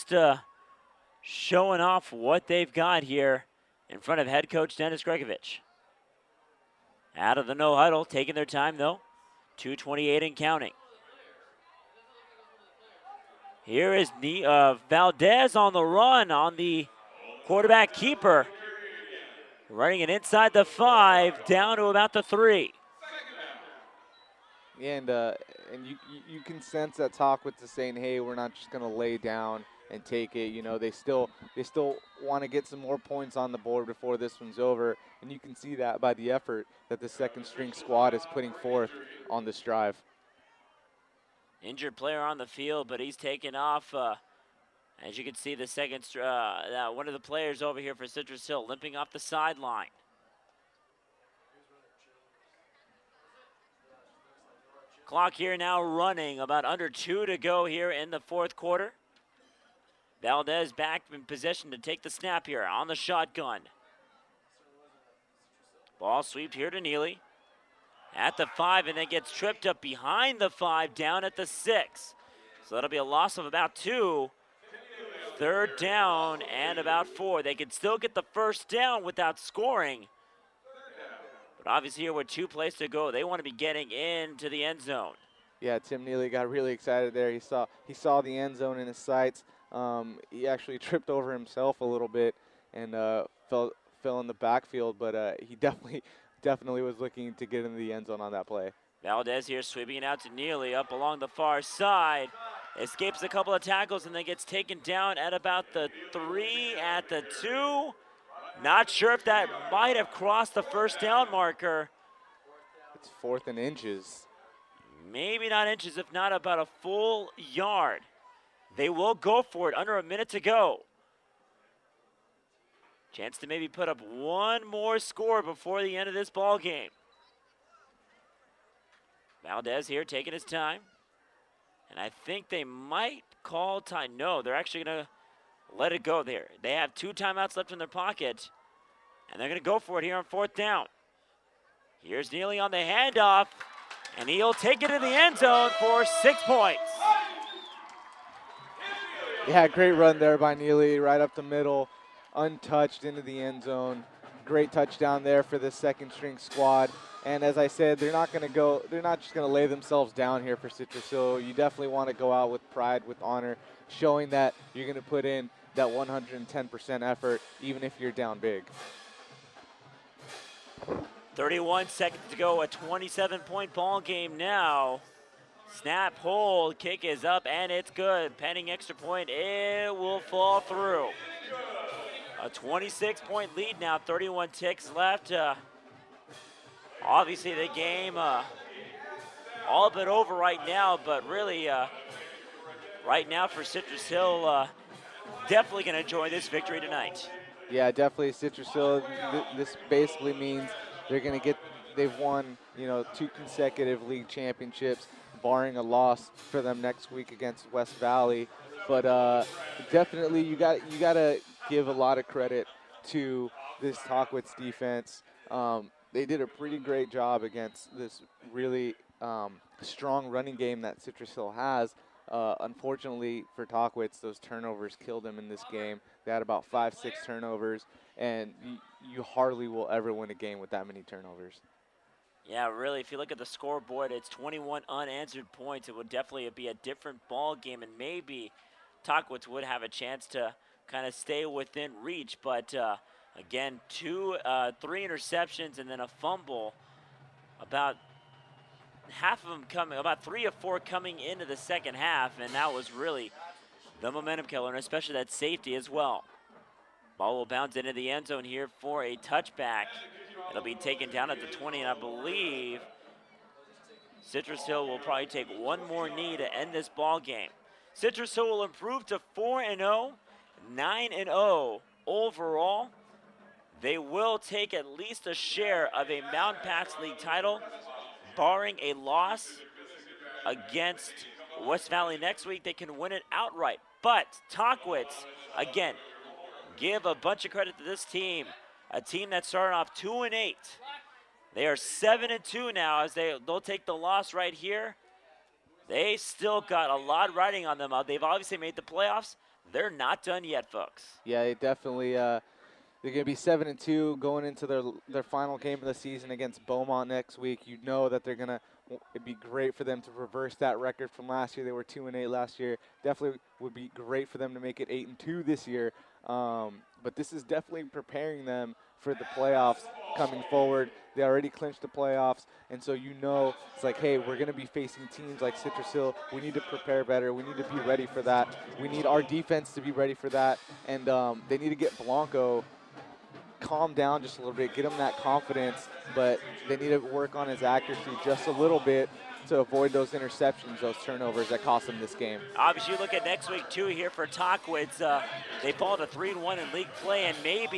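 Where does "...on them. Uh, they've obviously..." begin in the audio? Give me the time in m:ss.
4:57.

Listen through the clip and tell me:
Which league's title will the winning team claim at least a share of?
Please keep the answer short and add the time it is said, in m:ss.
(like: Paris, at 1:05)
Mountain Pass League, at 4:36.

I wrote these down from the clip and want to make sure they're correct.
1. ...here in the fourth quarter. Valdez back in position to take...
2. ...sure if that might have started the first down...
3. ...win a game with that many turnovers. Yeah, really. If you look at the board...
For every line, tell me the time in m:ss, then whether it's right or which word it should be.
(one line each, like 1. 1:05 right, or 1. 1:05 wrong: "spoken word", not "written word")
1. 0:57 right
2. 1:48 wrong: "crossed", not "started"
3. 3:50 wrong: "scoreboard", not "board".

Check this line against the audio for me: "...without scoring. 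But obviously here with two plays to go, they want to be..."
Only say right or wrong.
right.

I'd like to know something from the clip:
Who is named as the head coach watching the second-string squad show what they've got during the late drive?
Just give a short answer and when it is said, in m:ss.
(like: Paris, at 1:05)
Dennis Gregovich, at 0:04.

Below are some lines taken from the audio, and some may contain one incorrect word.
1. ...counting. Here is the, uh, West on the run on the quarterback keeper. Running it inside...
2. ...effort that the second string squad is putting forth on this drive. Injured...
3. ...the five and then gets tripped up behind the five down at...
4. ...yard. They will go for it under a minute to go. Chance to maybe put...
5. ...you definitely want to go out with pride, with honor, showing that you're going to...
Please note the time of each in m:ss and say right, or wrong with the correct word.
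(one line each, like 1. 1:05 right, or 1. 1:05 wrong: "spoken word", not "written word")
1. 0:10 wrong: "Valdez", not "West"
2. 0:36 right
3. 1:08 right
4. 1:57 right
5. 2:41 right.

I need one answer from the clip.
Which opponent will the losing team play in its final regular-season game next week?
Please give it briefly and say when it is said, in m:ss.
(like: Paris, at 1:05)
Beaumont, at 5:06.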